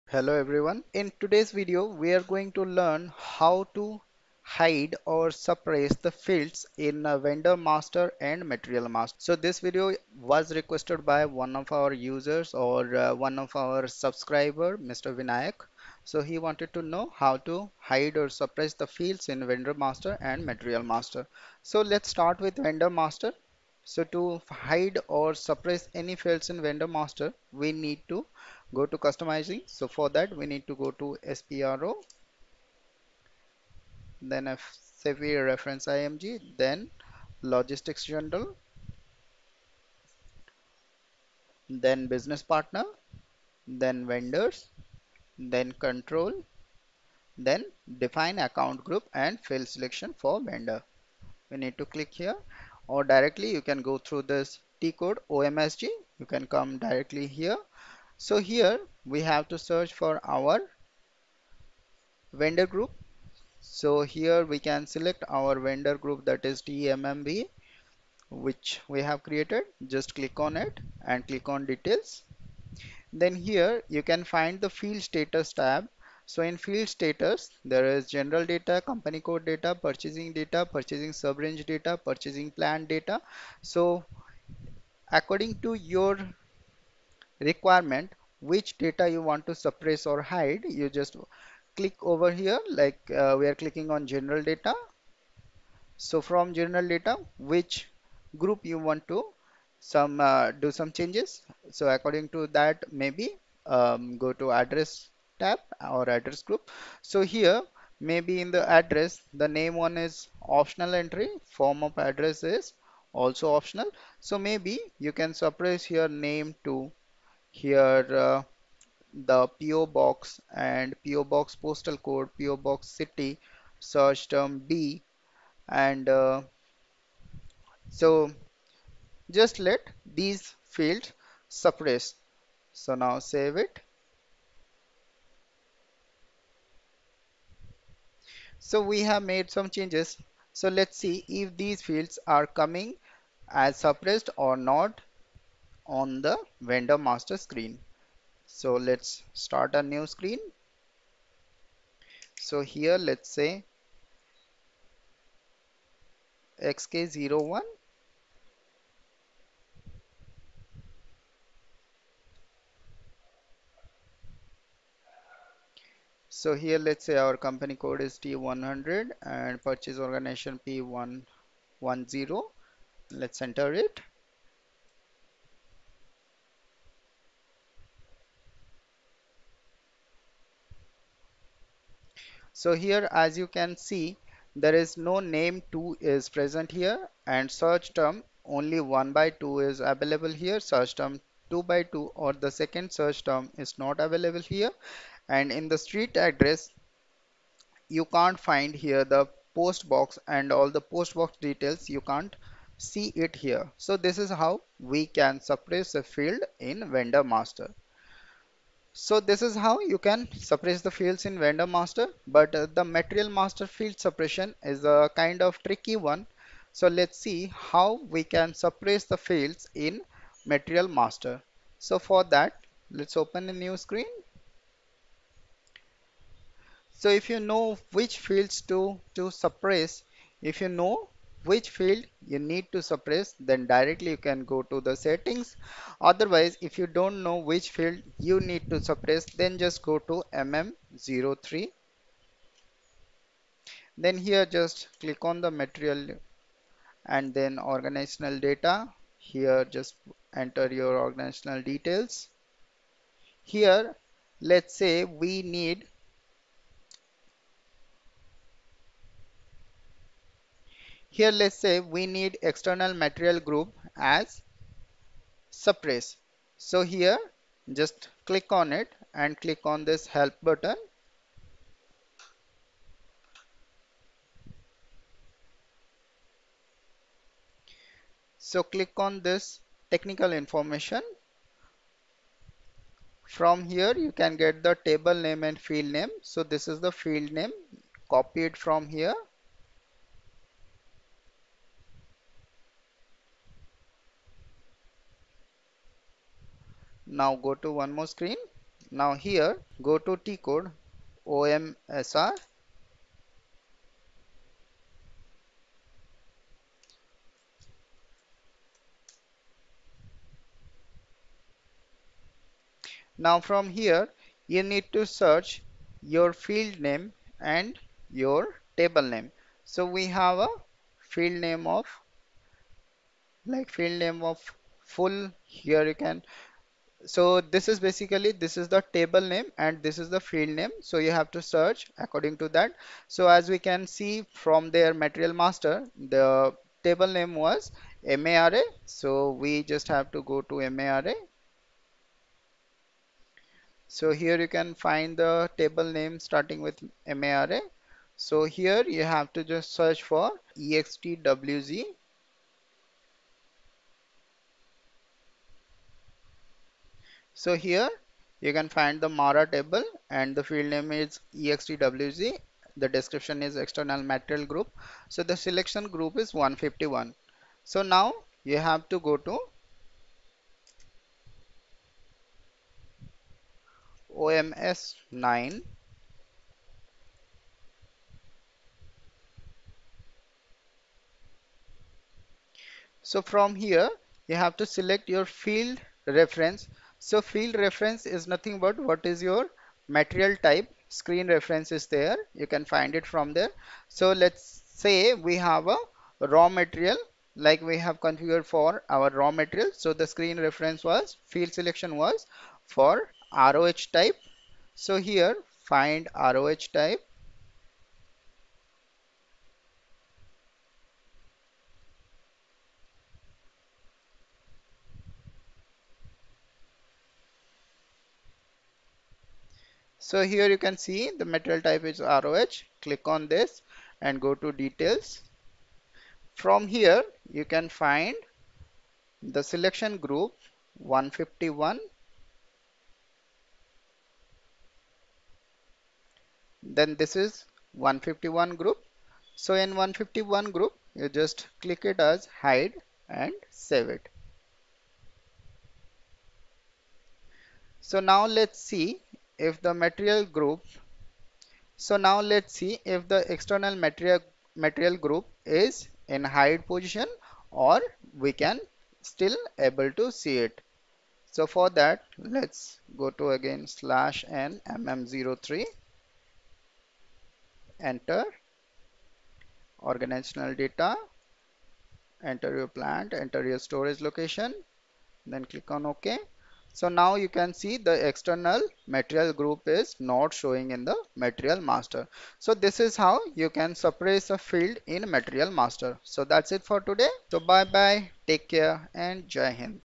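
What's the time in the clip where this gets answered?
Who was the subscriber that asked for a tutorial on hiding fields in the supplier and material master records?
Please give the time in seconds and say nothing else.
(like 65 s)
15 s.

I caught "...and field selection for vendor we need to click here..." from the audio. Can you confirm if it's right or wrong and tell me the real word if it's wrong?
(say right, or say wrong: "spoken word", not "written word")
right.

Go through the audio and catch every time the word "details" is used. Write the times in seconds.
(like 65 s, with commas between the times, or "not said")
71 s, 201 s, 251 s, 424 s.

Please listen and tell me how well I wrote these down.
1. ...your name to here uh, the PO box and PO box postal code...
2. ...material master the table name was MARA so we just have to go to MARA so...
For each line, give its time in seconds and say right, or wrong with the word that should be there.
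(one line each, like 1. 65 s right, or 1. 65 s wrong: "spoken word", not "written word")
1. 115 s right
2. 334 s right.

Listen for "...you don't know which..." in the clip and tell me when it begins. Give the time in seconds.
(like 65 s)
236 s.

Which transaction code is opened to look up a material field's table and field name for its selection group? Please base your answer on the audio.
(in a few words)
OMSR.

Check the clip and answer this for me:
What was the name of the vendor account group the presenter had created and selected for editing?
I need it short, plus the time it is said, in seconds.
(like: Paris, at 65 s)
TMMB, at 66 s.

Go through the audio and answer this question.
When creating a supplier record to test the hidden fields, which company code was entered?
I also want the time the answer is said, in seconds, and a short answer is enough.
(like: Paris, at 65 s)
T100, at 168 s.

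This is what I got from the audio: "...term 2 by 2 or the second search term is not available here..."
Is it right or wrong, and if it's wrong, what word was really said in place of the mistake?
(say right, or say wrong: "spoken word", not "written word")
right.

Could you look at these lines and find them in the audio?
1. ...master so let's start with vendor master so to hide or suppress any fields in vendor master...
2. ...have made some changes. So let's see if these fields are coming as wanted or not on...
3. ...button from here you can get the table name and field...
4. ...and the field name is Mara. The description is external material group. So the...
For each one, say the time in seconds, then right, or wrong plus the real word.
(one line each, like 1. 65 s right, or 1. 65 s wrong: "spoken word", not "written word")
1. 20 s right
2. 139 s wrong: "suppressed", not "wanted"
3. 280 s wrong: "information", not "button"
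4. 360 s wrong: "EXTWZ", not "Mara".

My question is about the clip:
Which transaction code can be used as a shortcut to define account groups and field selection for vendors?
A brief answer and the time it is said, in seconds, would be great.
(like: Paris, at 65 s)
OMSG, at 55 s.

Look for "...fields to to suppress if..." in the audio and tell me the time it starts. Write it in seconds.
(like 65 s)
228 s.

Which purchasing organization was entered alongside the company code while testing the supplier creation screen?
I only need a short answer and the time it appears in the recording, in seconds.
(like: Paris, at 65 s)
P110, at 170 s.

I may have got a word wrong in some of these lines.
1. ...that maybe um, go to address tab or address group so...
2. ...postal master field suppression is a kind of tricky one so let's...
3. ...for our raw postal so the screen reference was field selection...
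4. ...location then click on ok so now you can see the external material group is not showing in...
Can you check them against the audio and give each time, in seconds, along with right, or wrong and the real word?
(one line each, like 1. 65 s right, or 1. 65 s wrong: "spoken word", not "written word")
1. 102 s right
2. 212 s wrong: "material", not "postal"
3. 398 s wrong: "material", not "postal"
4. 474 s right.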